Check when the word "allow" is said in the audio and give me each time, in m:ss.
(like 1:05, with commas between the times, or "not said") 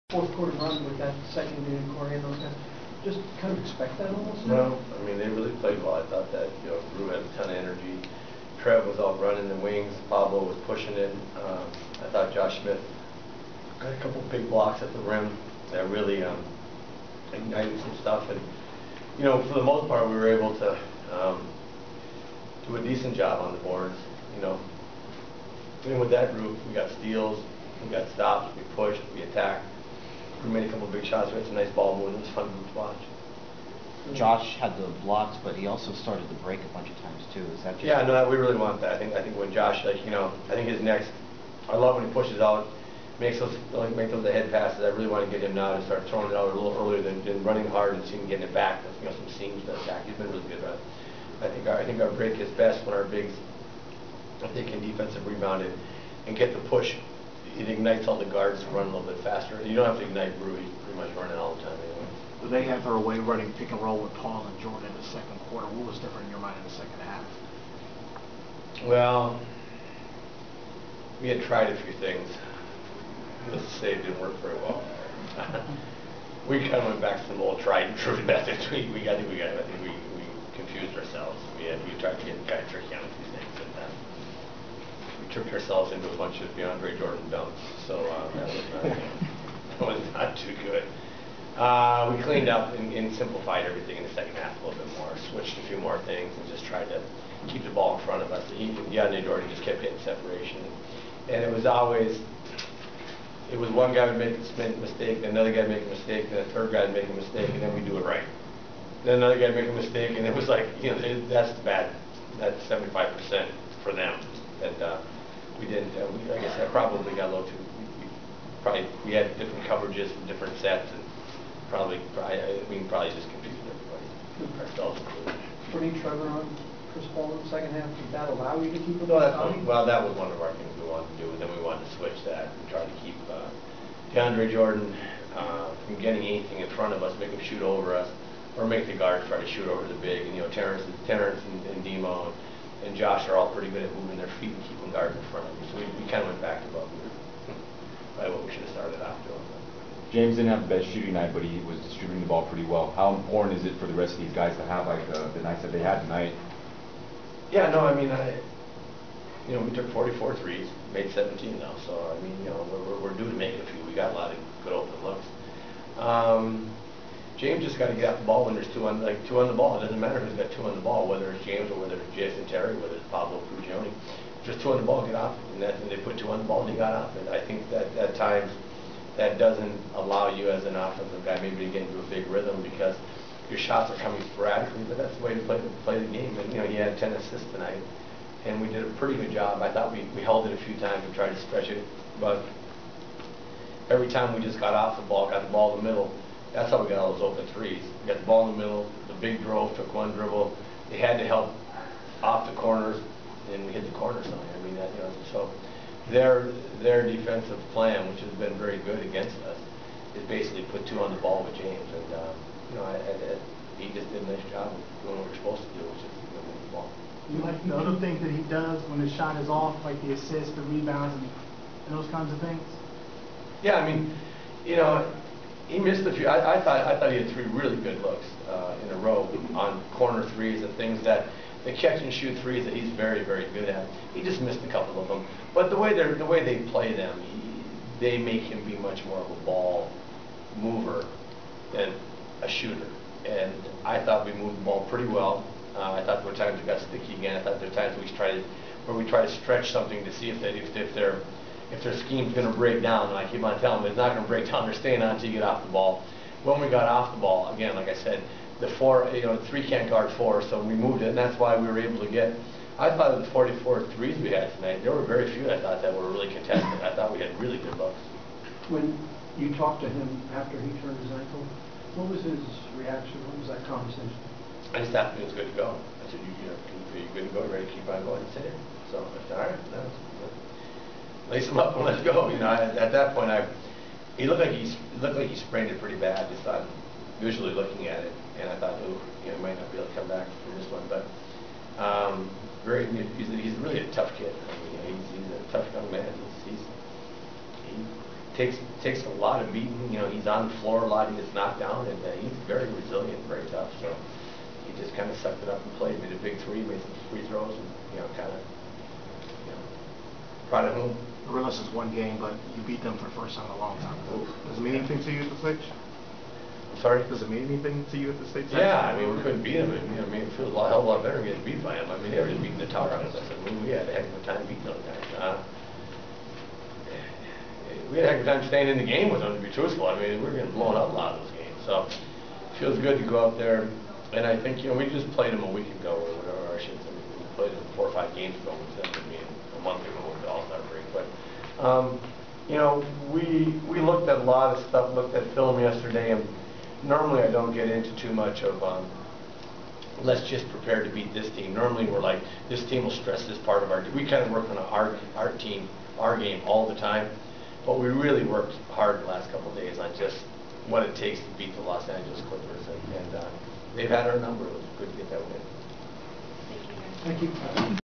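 2:08, 2:59.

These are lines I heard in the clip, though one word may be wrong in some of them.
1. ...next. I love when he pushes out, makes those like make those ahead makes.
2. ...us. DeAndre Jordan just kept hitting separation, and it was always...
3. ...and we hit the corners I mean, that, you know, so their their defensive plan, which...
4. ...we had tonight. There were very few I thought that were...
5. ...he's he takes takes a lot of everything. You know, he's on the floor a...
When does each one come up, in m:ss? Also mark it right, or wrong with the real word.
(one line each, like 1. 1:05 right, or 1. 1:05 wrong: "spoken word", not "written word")
1. 0:40 wrong: "passes", not "makes"
2. 1:38 right
3. 3:23 right
4. 4:24 right
5. 4:56 wrong: "beating", not "everything".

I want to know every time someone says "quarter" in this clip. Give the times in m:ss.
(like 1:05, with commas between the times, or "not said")
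0:00, 1:05.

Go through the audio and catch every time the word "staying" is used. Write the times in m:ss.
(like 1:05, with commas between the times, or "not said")
4:14, 5:28.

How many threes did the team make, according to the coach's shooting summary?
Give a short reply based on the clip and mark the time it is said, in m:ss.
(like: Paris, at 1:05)
17, at 2:41.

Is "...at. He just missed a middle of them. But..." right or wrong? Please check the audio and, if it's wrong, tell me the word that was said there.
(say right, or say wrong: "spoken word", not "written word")
wrong: "couple", not "middle".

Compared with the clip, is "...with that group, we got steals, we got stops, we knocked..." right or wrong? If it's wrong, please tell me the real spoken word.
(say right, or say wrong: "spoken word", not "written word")
wrong: "pushed", not "knocked".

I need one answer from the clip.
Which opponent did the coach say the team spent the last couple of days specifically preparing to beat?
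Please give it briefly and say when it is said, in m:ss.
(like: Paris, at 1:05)
Los Angeles Clippers, at 6:01.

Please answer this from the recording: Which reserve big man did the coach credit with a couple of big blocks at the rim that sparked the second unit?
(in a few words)
Josh Smith.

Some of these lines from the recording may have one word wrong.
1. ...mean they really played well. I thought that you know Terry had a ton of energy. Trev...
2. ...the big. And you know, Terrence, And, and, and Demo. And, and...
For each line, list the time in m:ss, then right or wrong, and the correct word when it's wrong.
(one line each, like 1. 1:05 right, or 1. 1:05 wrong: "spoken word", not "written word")
1. 0:05 wrong: "Rue", not "Terry"
2. 2:19 wrong: "Terrence", not "And".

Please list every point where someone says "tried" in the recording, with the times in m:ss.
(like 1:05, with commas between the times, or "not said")
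1:11, 1:17, 1:36, 3:11, 4:08.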